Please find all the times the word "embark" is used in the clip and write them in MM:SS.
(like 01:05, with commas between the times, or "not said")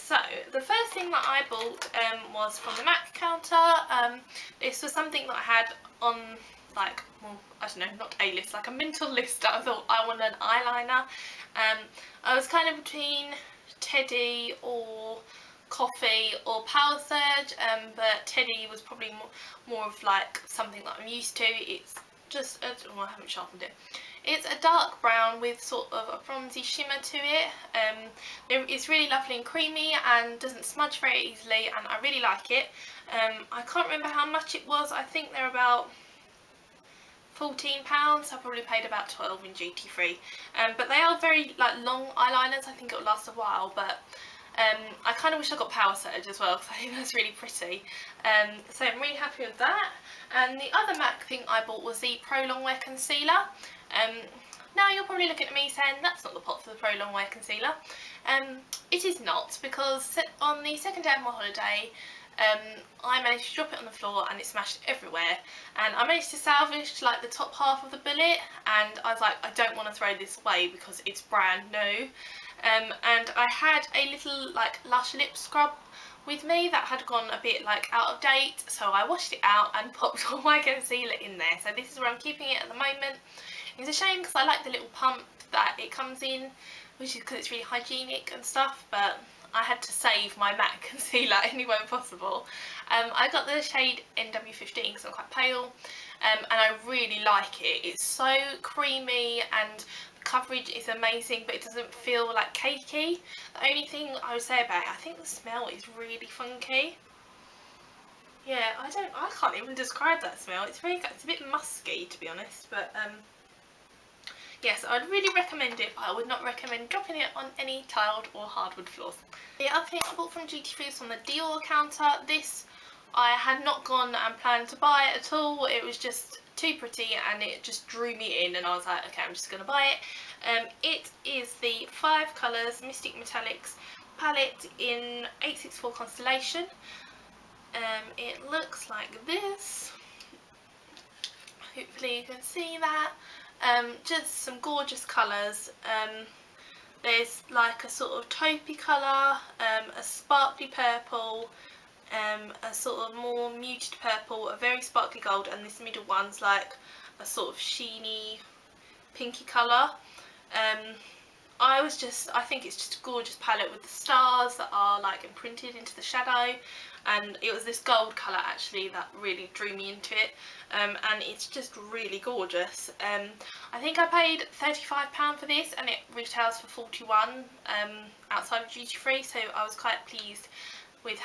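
not said.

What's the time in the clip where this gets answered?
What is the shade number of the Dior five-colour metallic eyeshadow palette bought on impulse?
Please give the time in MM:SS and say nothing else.
02:15.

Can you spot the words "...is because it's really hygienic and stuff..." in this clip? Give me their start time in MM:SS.
01:27.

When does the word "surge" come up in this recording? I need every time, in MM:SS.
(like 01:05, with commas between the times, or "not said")
00:16, 00:45.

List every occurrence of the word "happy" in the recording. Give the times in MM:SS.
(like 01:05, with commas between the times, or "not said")
00:49.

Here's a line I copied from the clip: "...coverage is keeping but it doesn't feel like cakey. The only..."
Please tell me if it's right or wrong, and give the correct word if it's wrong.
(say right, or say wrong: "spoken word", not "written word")
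wrong: "amazing", not "keeping".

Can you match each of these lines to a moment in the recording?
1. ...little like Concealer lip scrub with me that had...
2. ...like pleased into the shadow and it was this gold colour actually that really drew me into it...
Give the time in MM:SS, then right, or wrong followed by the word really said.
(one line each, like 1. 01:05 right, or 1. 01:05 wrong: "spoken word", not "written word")
1. 01:14 wrong: "Lush", not "Concealer"
2. 02:45 wrong: "imprinted", not "pleased".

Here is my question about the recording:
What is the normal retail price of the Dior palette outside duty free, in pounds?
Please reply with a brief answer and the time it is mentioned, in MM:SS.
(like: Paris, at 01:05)
£41, at 02:56.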